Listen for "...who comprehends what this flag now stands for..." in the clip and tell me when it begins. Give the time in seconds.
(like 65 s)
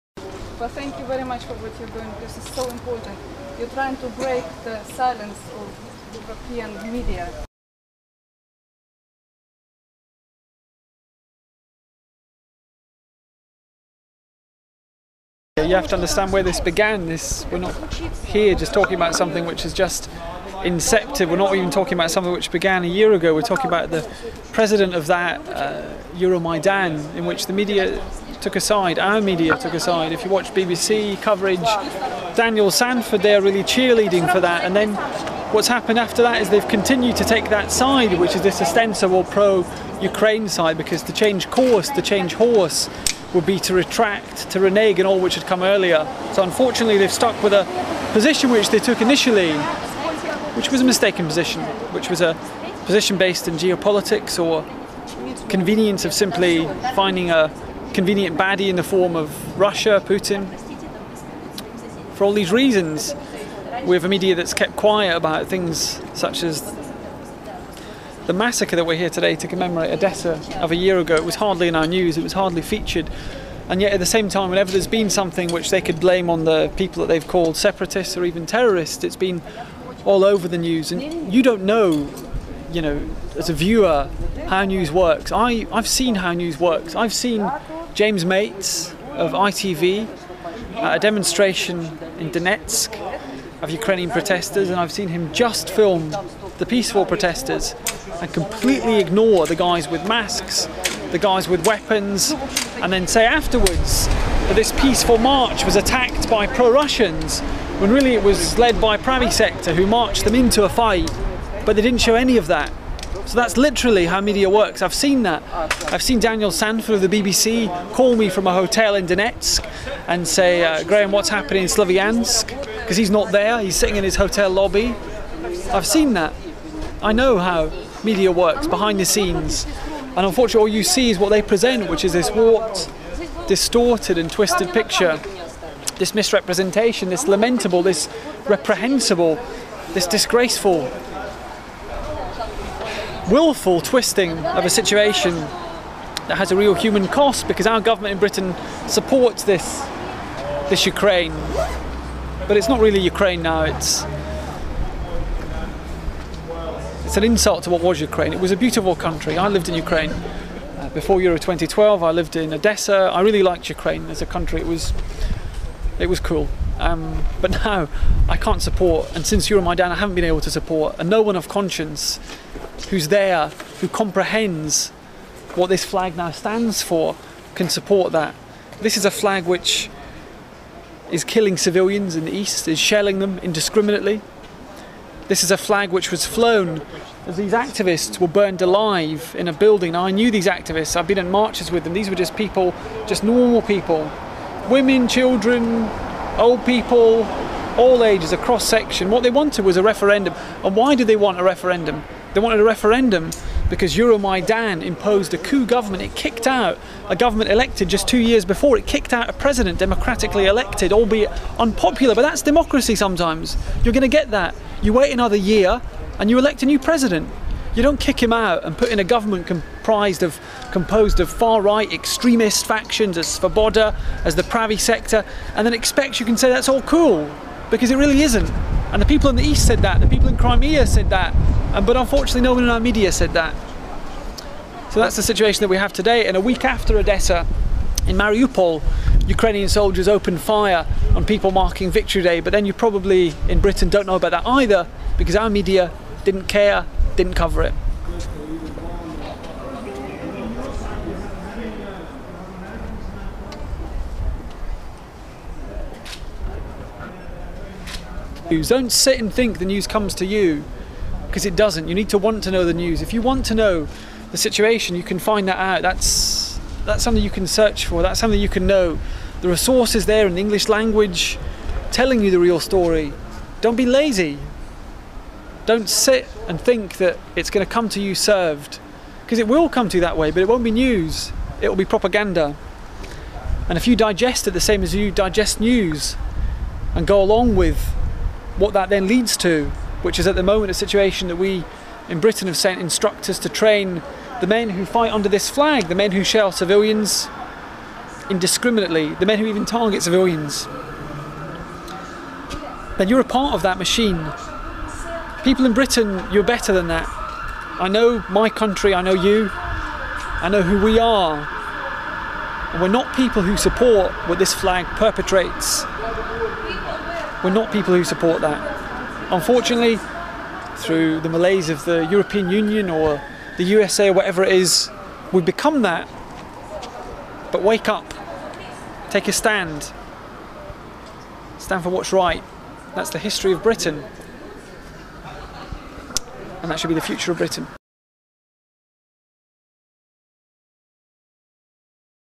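173 s.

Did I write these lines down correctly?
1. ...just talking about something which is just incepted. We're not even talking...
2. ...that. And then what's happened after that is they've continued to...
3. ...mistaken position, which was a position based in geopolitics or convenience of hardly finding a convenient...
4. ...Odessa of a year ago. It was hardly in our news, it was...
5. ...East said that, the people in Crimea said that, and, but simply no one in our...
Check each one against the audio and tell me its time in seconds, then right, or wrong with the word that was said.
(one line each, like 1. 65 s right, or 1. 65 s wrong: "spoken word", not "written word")
1. 18 s right
2. 34 s right
3. 50 s wrong: "simply", not "hardly"
4. 69 s right
5. 229 s wrong: "unfortunately", not "simply".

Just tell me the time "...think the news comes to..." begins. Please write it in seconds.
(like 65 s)
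259 s.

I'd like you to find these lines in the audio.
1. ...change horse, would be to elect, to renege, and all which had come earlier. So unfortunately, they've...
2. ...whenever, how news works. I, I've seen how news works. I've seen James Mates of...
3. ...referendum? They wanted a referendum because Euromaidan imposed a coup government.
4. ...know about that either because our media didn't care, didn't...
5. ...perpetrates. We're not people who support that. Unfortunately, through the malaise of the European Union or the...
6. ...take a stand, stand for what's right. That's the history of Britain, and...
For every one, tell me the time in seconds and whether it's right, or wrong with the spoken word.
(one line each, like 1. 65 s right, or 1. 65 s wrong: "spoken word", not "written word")
1. 42 s wrong: "retract", not "elect"
2. 83 s wrong: "viewer", not "whenever"
3. 201 s right
4. 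244 s right
5. 314 s right
6. 329 s right.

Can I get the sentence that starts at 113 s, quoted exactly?
So that's literally how media works.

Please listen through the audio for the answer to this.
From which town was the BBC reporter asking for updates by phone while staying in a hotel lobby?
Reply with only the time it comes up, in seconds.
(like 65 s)
121 s.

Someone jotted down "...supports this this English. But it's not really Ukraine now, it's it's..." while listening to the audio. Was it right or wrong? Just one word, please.
wrong.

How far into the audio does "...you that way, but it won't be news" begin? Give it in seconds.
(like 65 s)
279 s.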